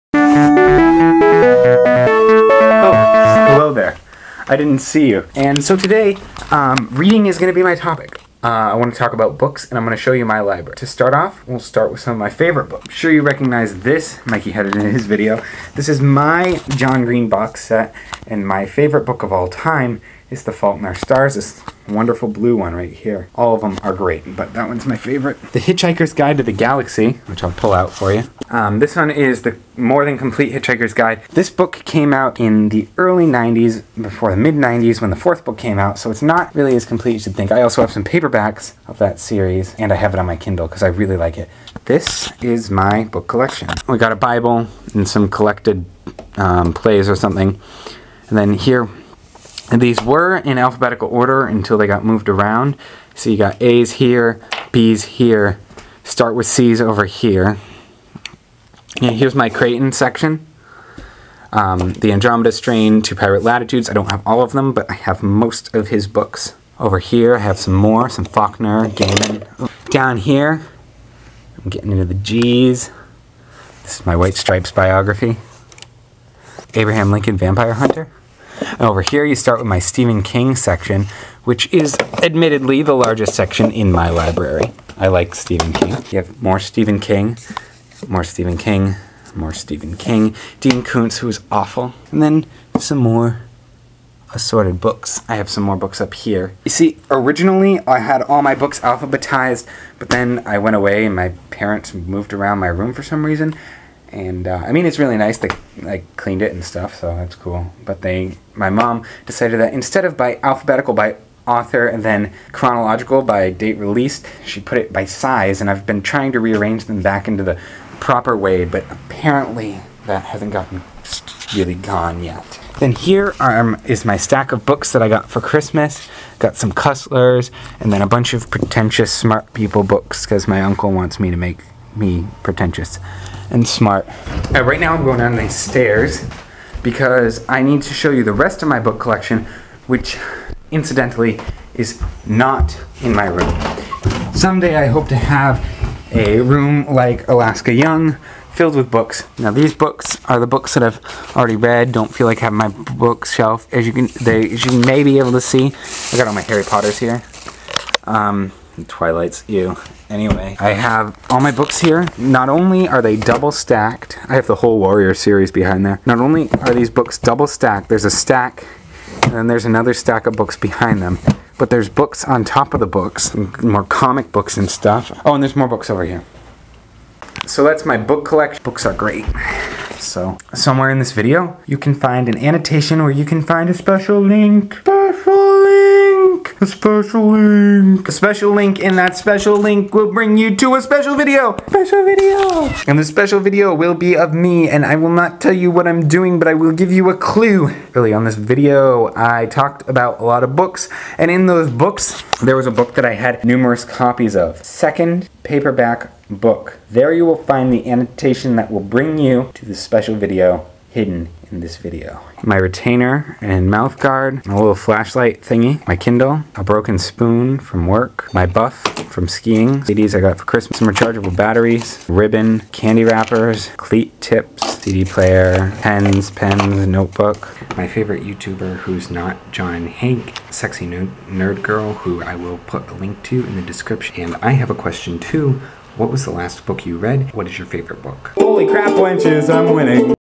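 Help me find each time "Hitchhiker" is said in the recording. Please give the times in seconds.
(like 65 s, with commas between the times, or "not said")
25 s, 30 s.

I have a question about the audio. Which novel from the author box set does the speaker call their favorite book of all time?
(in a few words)
The Fault in Our Stars.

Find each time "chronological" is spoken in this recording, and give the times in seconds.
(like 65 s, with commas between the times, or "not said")
112 s.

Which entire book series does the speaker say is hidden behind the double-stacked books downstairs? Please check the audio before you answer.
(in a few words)
Warrior series.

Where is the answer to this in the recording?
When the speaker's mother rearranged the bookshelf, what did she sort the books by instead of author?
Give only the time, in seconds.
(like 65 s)
115 s.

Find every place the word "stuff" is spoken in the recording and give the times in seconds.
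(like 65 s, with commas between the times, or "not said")
106 s, 174 s.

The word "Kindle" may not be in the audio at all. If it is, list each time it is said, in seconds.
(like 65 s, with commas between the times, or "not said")
40 s, 215 s.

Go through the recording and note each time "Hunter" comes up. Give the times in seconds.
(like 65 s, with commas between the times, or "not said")
77 s.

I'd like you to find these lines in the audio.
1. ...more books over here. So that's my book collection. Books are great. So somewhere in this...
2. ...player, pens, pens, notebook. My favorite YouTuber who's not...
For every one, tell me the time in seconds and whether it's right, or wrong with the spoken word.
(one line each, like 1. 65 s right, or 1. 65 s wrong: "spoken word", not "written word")
1. 175 s right
2. 225 s right.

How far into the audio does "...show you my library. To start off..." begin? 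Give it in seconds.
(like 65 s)
10 s.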